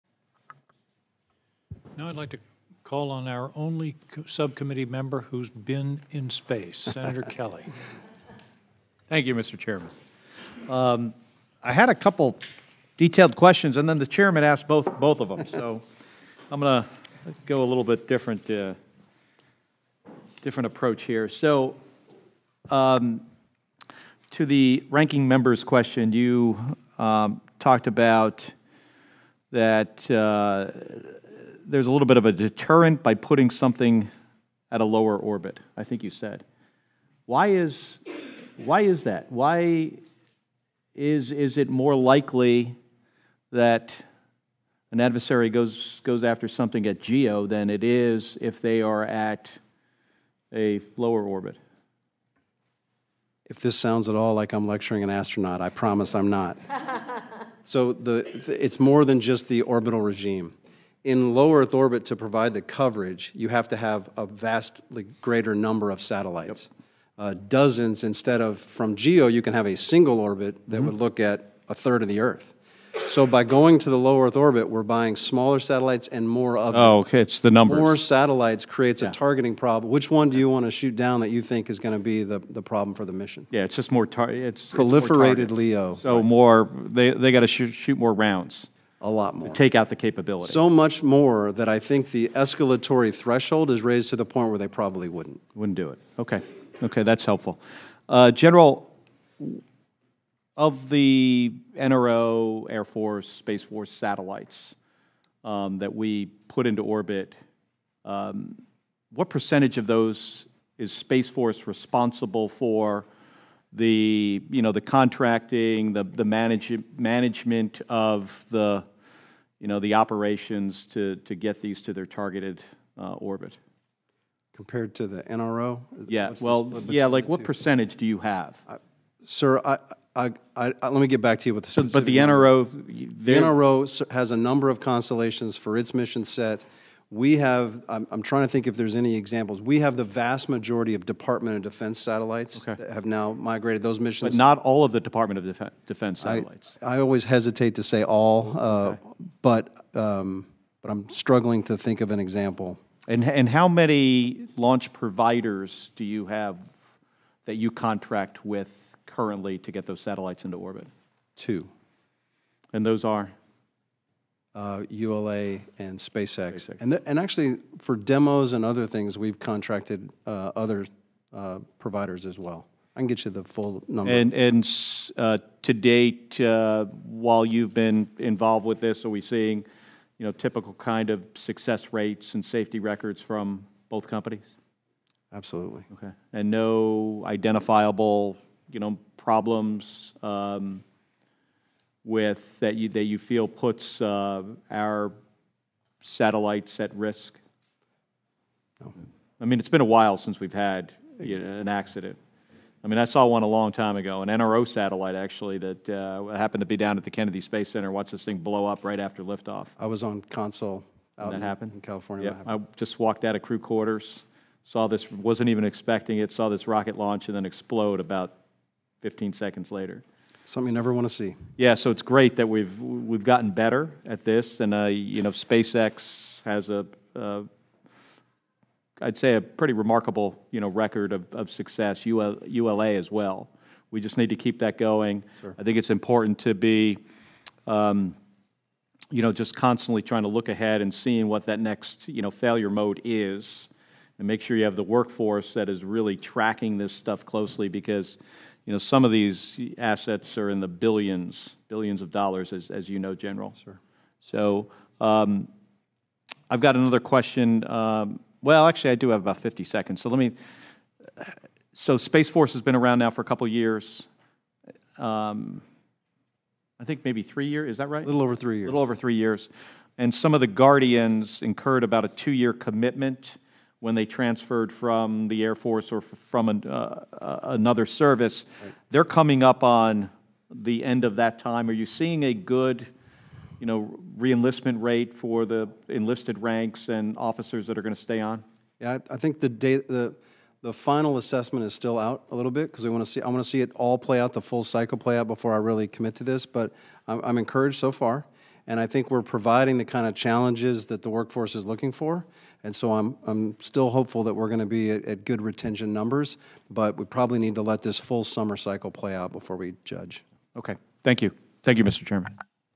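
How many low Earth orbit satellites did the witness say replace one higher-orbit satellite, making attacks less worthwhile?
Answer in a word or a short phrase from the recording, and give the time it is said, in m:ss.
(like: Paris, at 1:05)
Dozens, at 1:07.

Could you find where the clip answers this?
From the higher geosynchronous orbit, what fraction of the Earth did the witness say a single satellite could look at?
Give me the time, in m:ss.
1:11.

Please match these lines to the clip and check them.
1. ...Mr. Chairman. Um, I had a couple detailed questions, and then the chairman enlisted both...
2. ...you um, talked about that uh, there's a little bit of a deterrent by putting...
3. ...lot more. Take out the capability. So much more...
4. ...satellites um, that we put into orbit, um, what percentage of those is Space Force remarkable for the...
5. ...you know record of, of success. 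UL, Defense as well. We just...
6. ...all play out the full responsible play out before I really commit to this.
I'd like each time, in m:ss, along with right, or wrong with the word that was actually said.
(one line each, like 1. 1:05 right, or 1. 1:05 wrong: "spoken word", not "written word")
1. 0:09 wrong: "asked", not "enlisted"
2. 0:26 right
3. 1:29 right
4. 1:43 wrong: "responsible", not "remarkable"
5. 3:50 wrong: "ULA", not "Defense"
6. 4:53 wrong: "cycle", not "responsible".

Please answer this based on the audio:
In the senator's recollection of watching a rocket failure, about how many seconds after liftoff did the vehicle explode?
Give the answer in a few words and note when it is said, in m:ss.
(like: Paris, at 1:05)
15, at 3:39.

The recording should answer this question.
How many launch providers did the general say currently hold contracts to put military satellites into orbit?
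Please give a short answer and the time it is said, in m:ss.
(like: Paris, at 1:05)
2, at 2:41.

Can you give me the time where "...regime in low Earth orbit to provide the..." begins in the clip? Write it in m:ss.
0:59.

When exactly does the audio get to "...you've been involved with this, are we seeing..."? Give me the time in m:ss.
2:57.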